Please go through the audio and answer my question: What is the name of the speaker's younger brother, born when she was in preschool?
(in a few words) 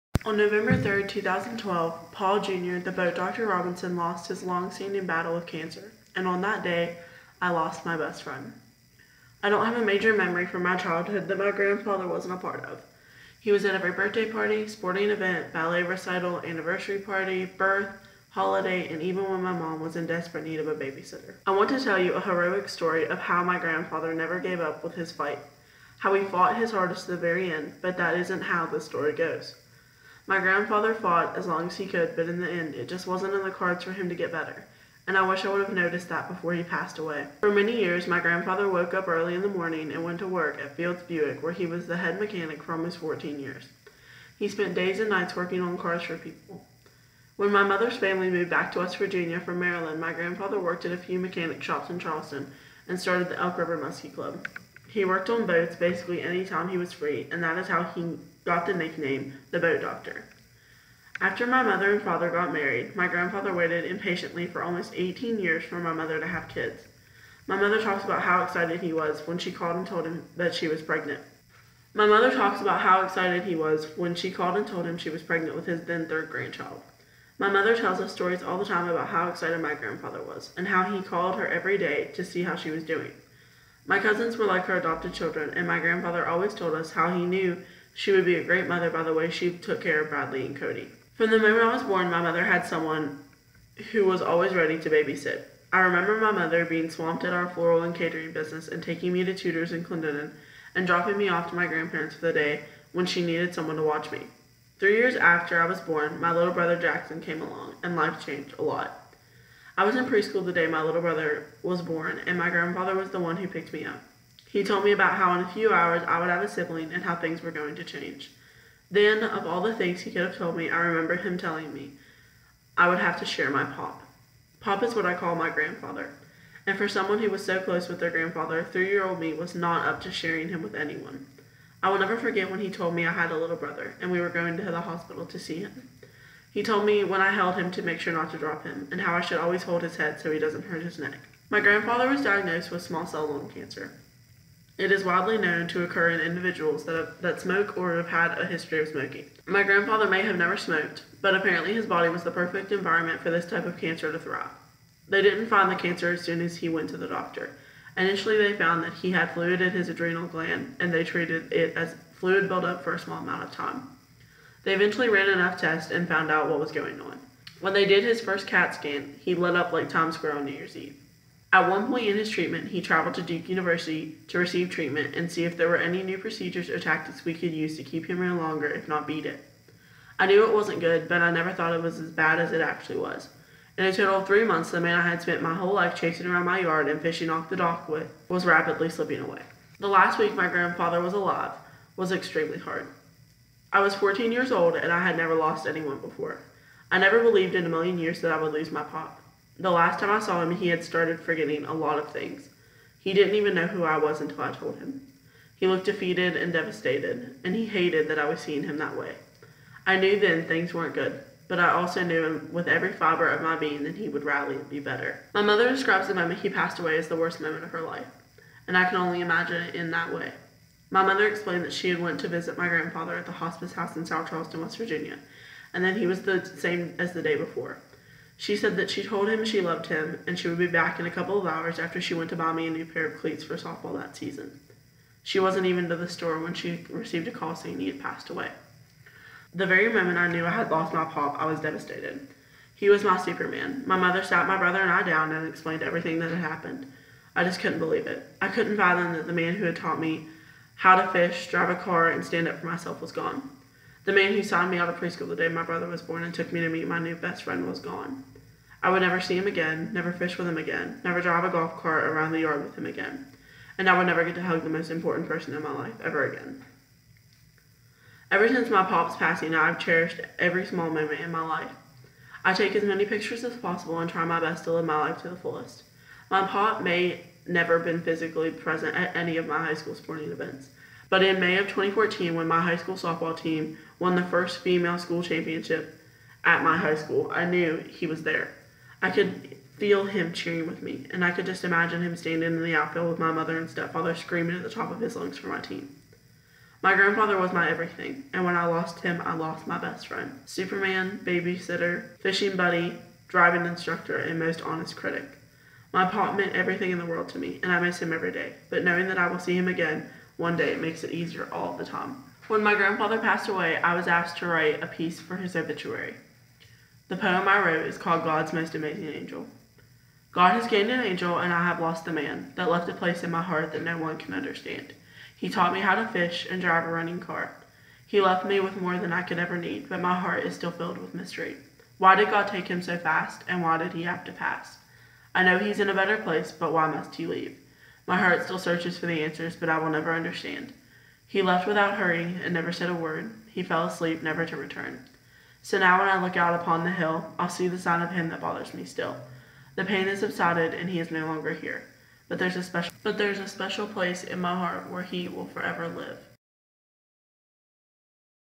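Jackson.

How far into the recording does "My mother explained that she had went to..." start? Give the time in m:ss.
3:40.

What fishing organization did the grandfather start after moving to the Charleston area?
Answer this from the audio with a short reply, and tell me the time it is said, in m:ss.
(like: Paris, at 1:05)
Elk River Muskie Club, at 0:53.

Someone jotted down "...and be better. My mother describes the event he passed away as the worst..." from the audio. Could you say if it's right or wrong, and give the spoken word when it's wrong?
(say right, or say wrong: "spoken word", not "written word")
wrong: "moment", not "event".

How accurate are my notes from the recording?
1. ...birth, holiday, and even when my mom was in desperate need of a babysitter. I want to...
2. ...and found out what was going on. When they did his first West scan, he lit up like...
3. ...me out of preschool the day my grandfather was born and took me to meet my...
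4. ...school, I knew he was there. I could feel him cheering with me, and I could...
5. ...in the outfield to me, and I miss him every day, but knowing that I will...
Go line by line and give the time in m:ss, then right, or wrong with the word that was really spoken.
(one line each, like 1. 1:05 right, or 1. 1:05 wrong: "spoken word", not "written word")
1. 0:17 right
2. 2:45 wrong: "CAT", not "West"
3. 4:14 wrong: "brother", not "grandfather"
4. 4:46 right
5. 5:06 wrong: "world", not "outfield".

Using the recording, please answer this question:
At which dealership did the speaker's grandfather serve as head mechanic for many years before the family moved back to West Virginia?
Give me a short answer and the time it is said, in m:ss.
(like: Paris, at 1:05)
Fields Buick, at 0:40.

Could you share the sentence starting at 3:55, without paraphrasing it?
She wasn't even to the store when she received a call saying he had passed away.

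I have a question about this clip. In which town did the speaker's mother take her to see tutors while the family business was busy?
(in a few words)
Clendenin.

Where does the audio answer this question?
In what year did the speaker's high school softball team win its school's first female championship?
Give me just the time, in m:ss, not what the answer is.
4:41.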